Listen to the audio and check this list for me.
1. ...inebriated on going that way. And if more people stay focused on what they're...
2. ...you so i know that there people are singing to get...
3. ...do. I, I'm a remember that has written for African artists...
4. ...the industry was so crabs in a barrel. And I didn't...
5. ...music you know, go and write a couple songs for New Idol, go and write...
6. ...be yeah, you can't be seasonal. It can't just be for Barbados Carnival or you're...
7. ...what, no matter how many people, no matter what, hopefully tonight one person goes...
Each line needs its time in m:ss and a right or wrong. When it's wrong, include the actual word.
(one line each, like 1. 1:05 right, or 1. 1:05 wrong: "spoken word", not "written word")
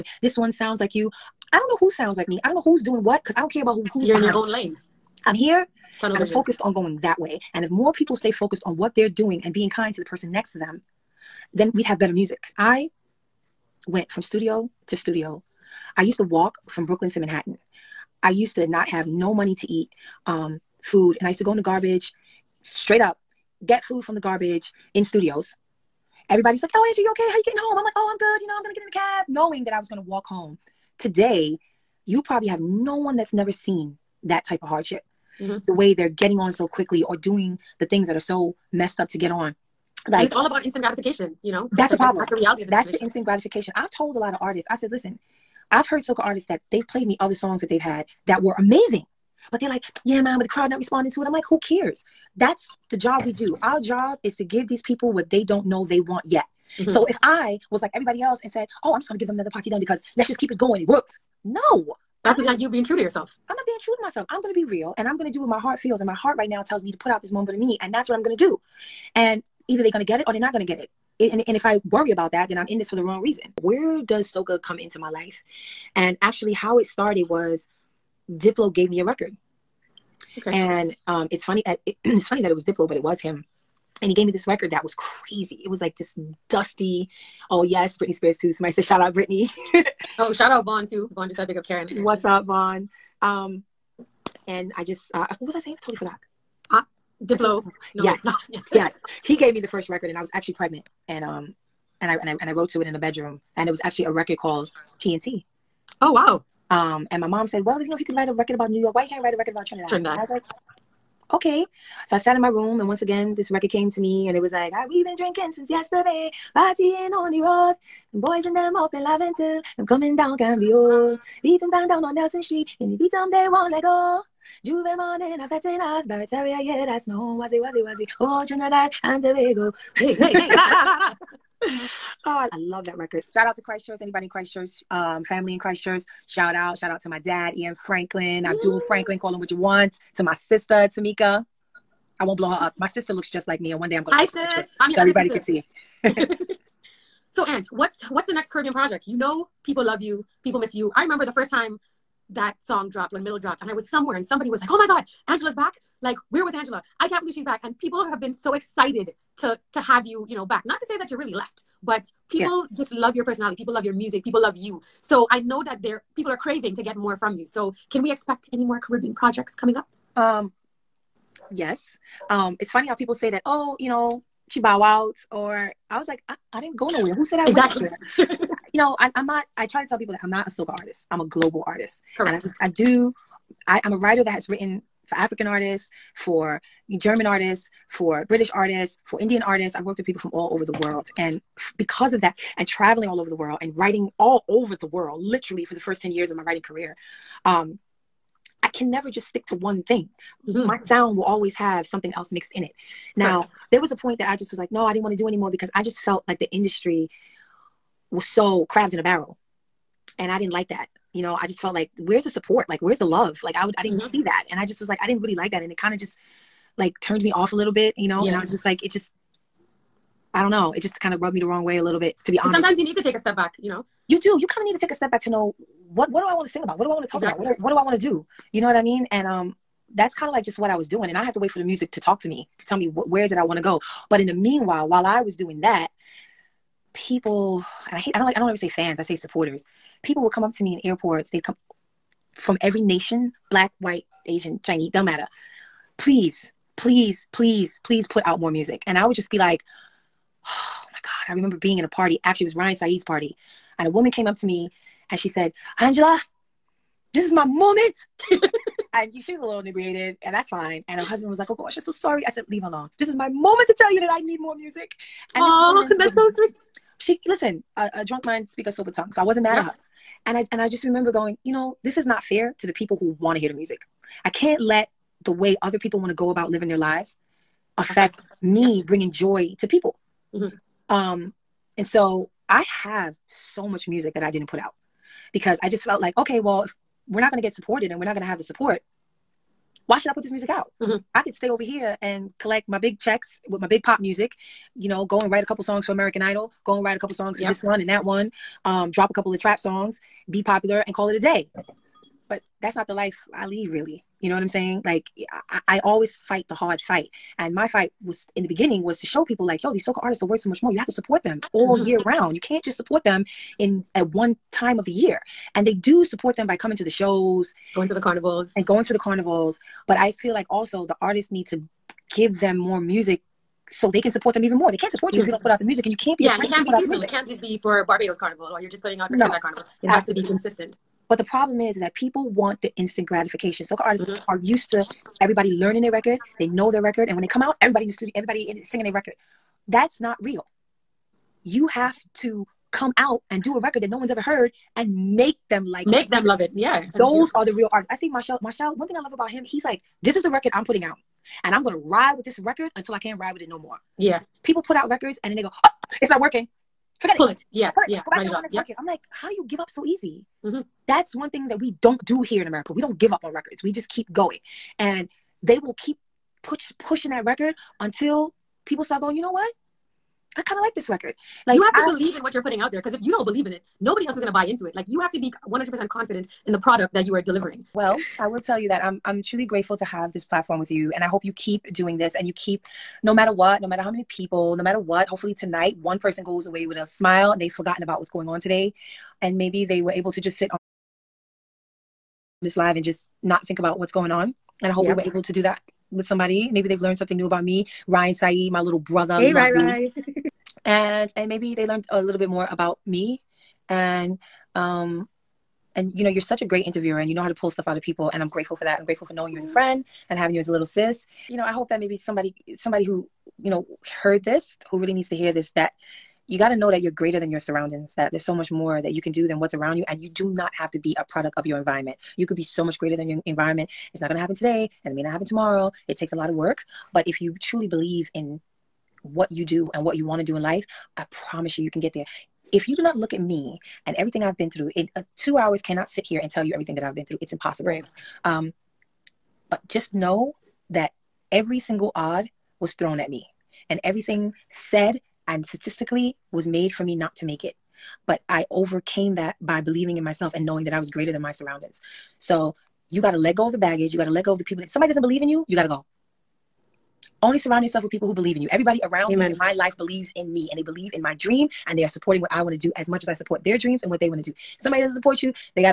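1. 0:06 wrong: "focused", not "inebriated"
2. 2:44 wrong: "craving", not "singing"
3. 3:02 wrong: "writer", not "remember"
4. 3:26 right
5. 4:53 wrong: "American", not "New"
6. 5:26 right
7. 6:23 right.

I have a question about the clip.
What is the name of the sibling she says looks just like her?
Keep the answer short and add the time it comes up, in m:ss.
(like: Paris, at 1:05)
Tamika, at 2:20.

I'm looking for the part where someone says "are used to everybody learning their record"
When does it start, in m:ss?
5:34.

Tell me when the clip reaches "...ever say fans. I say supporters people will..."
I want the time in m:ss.
3:58.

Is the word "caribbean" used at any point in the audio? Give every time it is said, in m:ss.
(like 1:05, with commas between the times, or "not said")
2:28, 2:48.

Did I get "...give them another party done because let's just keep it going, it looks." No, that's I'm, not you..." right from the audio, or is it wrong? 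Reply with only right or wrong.
wrong.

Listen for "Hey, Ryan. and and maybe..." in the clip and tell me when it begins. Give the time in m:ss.
6:39.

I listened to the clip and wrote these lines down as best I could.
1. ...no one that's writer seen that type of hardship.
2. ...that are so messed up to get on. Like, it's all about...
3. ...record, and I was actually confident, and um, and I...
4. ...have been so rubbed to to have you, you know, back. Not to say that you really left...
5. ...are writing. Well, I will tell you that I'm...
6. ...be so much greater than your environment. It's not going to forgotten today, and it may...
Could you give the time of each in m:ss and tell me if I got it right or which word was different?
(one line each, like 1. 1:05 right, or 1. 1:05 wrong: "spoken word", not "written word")
1. 0:32 wrong: "never", not "writer"
2. 0:38 right
3. 1:39 wrong: "pregnant", not "confident"
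4. 2:38 wrong: "excited", not "rubbed"
5. 6:17 wrong: "delivering", not "writing"
6. 7:02 wrong: "happen", not "forgotten".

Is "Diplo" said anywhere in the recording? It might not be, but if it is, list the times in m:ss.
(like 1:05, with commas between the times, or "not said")
1:18, 1:22, 1:37.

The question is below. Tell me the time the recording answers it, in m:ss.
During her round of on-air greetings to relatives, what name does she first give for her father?
2:17.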